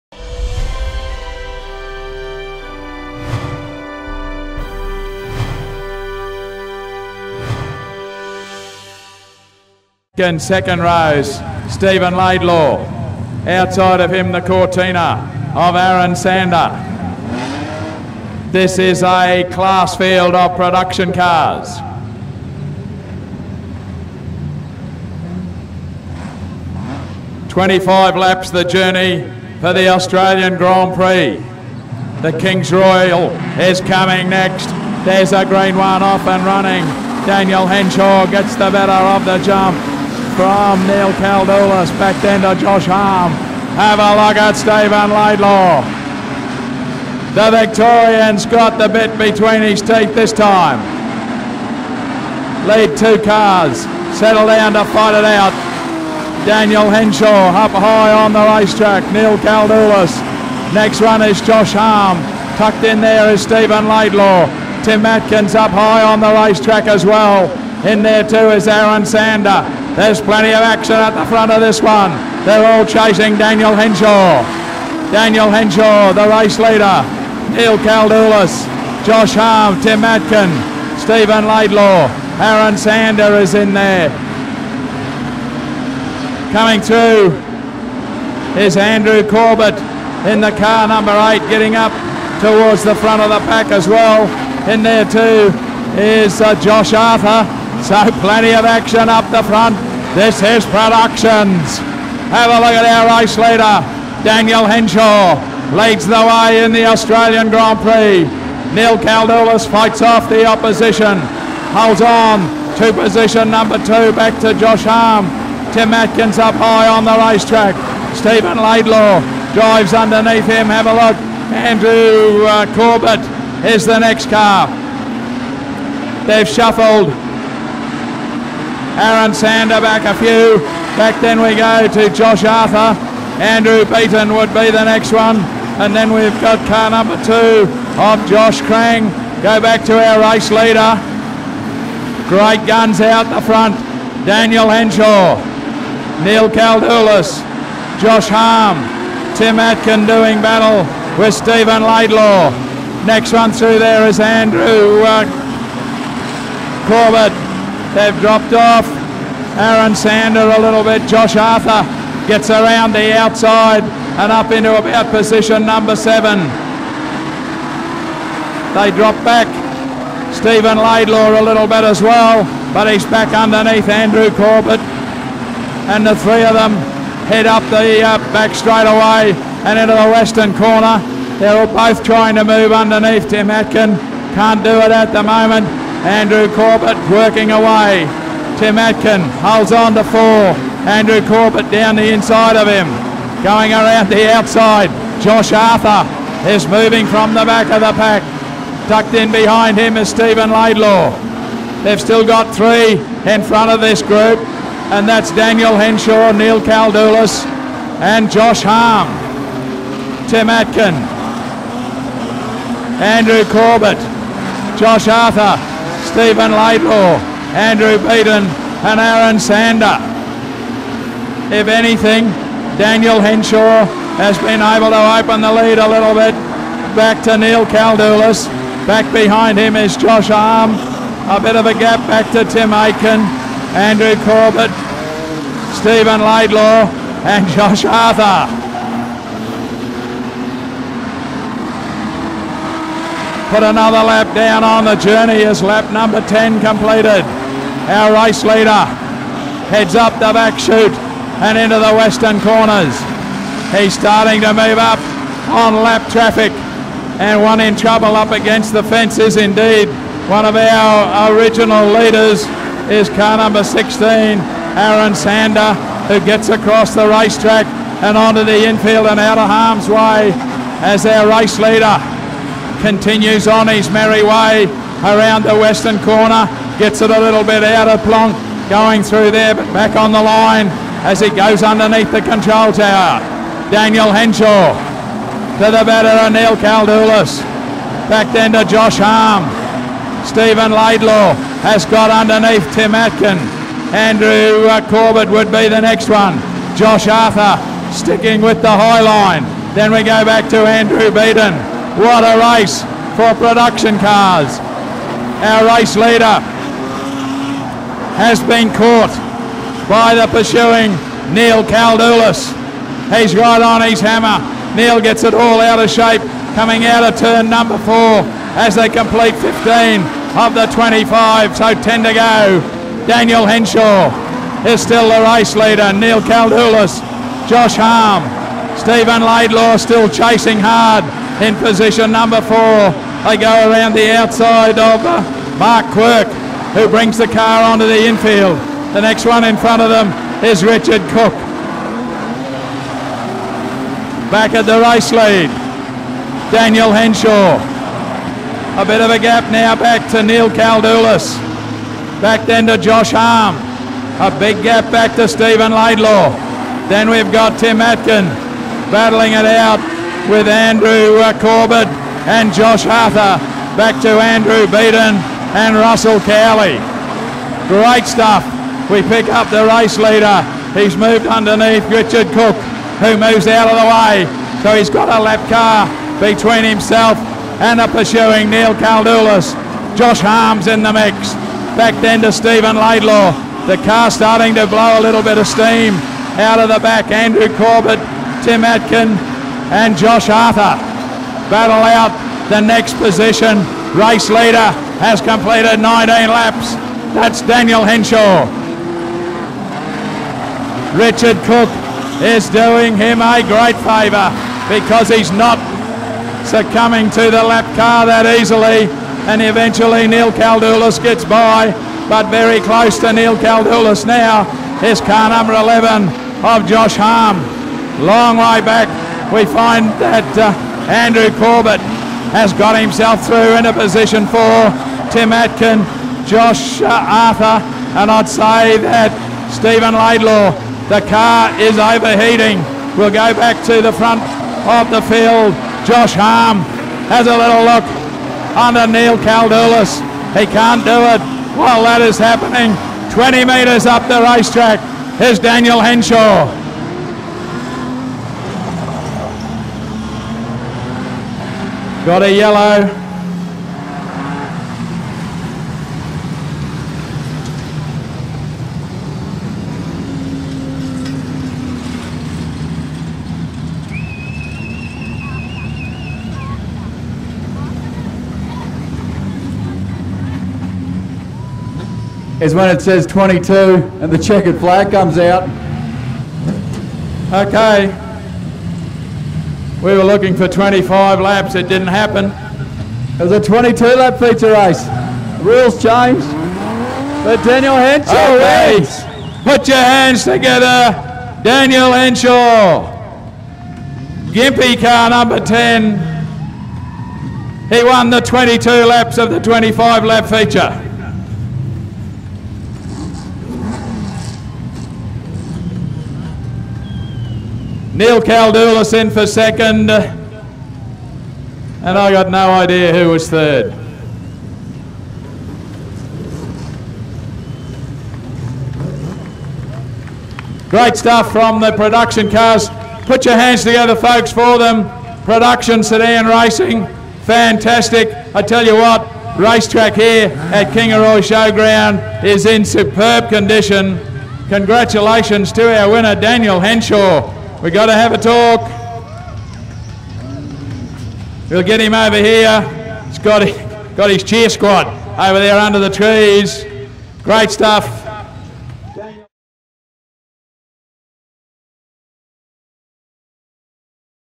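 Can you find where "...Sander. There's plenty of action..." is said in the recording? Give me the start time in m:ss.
1:09.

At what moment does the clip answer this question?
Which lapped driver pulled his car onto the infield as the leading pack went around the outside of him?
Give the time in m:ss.
5:35.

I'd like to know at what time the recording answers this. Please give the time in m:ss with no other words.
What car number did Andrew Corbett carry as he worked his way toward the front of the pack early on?
1:30.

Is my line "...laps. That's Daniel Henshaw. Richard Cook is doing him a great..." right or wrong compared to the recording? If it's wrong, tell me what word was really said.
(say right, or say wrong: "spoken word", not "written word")
right.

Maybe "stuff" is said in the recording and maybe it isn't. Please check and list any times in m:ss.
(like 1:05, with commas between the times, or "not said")
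6:08, 8:40, 9:07.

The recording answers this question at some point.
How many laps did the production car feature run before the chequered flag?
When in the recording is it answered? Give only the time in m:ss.
8:03.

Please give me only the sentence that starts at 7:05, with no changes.
Tim Atkin, Josh uh, Arthur, and I'd say that Stephen Laidlaw, the car is overheating.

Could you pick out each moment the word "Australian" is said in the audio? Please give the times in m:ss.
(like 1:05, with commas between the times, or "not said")
0:29, 1:46.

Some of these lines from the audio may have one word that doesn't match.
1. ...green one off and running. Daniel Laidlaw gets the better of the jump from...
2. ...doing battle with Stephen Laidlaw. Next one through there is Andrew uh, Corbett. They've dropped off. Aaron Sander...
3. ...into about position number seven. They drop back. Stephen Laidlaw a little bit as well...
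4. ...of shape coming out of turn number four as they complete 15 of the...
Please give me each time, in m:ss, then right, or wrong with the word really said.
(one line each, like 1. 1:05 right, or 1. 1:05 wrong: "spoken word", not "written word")
1. 0:35 wrong: "Henshaw", not "Laidlaw"
2. 2:30 right
3. 2:44 right
4. 5:15 right.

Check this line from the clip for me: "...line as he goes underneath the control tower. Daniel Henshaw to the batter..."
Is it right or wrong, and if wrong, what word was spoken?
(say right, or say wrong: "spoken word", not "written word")
right.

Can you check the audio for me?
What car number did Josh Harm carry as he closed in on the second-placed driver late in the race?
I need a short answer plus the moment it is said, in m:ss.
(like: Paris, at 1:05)
11, at 6:54.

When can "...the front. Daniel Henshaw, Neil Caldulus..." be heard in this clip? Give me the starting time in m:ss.
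2:23.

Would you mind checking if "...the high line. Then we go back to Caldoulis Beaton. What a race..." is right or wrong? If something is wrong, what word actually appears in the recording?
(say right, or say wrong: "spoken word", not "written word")
wrong: "Andrew", not "Caldoulis".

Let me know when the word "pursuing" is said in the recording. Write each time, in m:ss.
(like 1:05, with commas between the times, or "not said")
5:10, 6:17.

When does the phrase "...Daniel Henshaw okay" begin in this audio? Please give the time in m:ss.
8:07.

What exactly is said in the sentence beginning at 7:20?
He can't do it while that is happening.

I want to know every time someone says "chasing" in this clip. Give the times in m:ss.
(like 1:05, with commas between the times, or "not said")
1:12, 5:30.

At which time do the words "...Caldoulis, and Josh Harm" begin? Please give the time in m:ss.
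3:26.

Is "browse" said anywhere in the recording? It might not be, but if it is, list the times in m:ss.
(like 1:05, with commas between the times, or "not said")
not said.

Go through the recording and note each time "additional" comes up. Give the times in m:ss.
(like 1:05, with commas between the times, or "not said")
not said.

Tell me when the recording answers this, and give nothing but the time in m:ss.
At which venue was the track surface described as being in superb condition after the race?
8:50.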